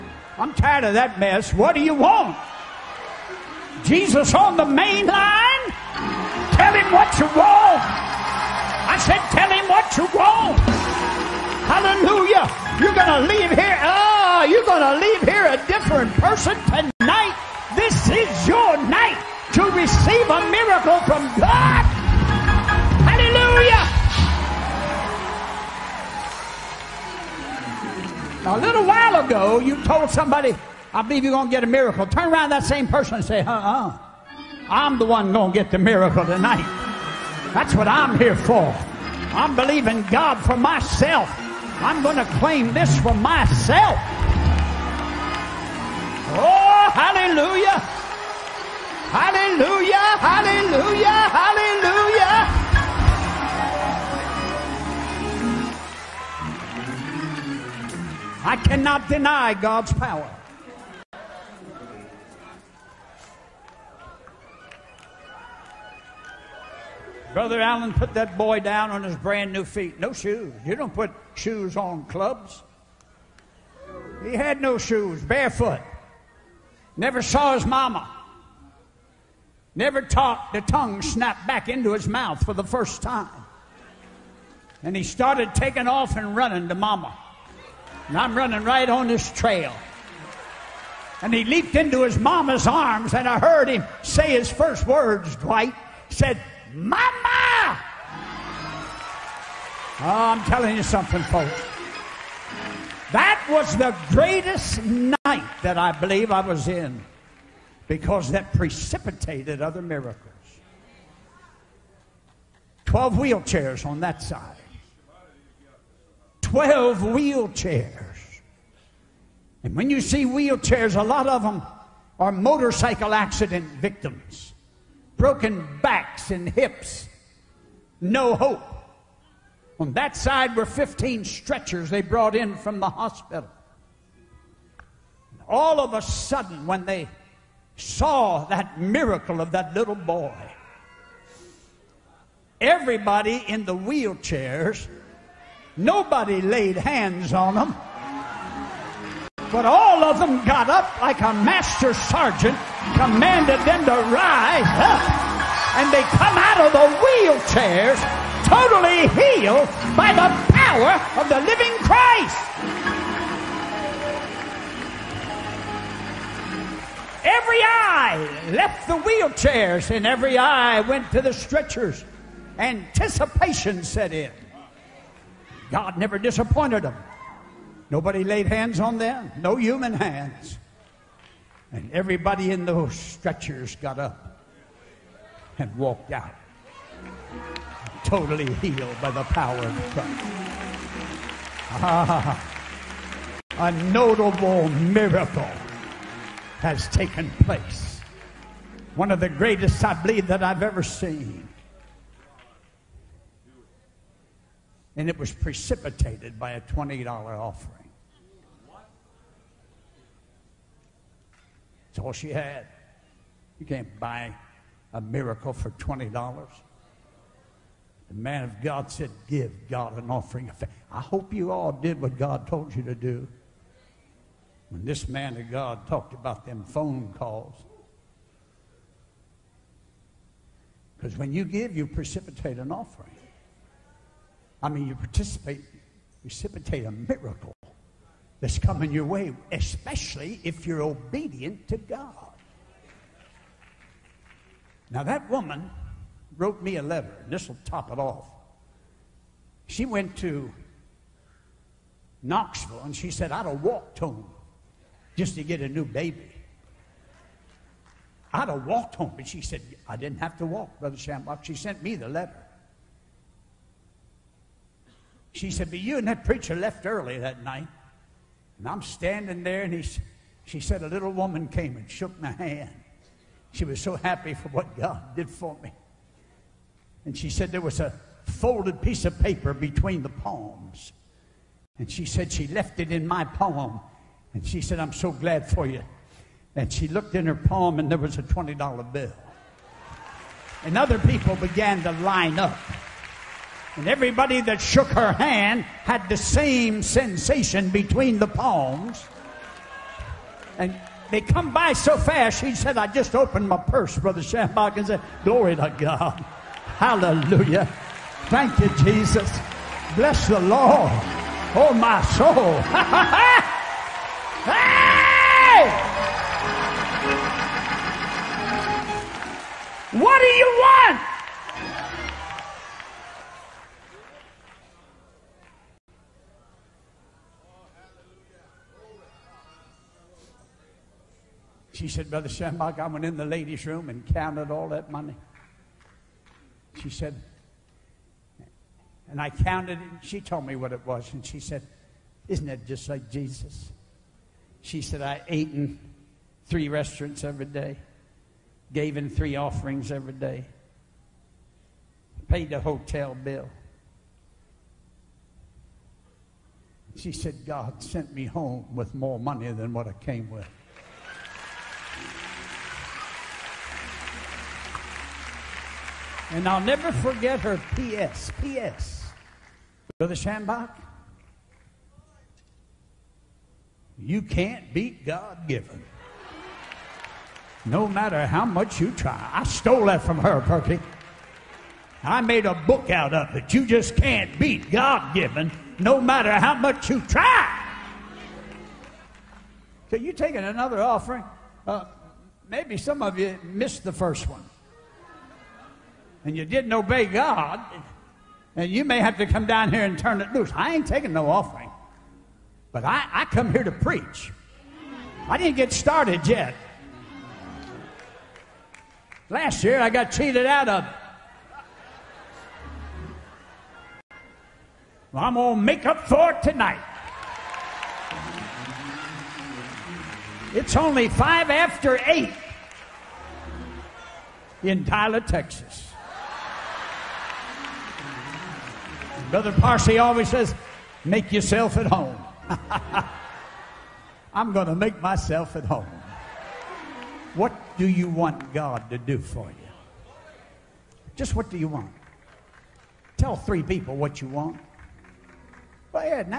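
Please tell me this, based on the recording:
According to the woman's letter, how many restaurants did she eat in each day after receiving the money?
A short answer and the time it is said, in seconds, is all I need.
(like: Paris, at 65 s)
3, at 346 s.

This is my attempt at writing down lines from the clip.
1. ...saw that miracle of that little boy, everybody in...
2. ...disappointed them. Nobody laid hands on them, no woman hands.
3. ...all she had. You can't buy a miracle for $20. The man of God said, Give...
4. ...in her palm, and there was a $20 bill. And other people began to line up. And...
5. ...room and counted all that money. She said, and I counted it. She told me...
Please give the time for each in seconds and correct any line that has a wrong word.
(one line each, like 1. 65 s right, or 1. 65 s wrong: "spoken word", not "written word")
1. 137 s right
2. 176 s wrong: "human", not "woman"
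3. 212 s right
4. 287 s right
5. 333 s right.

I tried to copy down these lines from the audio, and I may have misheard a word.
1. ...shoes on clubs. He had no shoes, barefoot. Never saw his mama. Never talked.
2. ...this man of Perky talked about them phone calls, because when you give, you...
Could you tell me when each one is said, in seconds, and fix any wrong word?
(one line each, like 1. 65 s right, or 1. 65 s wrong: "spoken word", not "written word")
1. 71 s right
2. 224 s wrong: "God", not "Perky".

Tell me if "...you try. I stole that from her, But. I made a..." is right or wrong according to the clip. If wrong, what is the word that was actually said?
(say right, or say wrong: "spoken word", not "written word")
wrong: "Perky", not "But".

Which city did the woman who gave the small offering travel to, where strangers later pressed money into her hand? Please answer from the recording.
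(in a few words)
Knoxville.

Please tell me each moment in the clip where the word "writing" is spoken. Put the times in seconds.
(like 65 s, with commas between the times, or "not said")
not said.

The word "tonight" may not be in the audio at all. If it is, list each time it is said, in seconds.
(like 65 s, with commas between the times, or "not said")
16 s, 36 s, 416 s.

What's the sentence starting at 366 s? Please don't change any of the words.
And I'll never forget her P.S.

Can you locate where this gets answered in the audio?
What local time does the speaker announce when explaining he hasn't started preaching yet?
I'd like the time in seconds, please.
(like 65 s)
421 s.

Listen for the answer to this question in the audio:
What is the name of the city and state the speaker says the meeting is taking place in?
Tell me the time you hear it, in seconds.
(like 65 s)
424 s.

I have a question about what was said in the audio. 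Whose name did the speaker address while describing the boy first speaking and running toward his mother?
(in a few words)
Dwight.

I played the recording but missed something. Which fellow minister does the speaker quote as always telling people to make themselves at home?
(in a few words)
Brother Parsley.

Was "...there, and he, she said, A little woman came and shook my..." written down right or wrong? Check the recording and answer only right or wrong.
right.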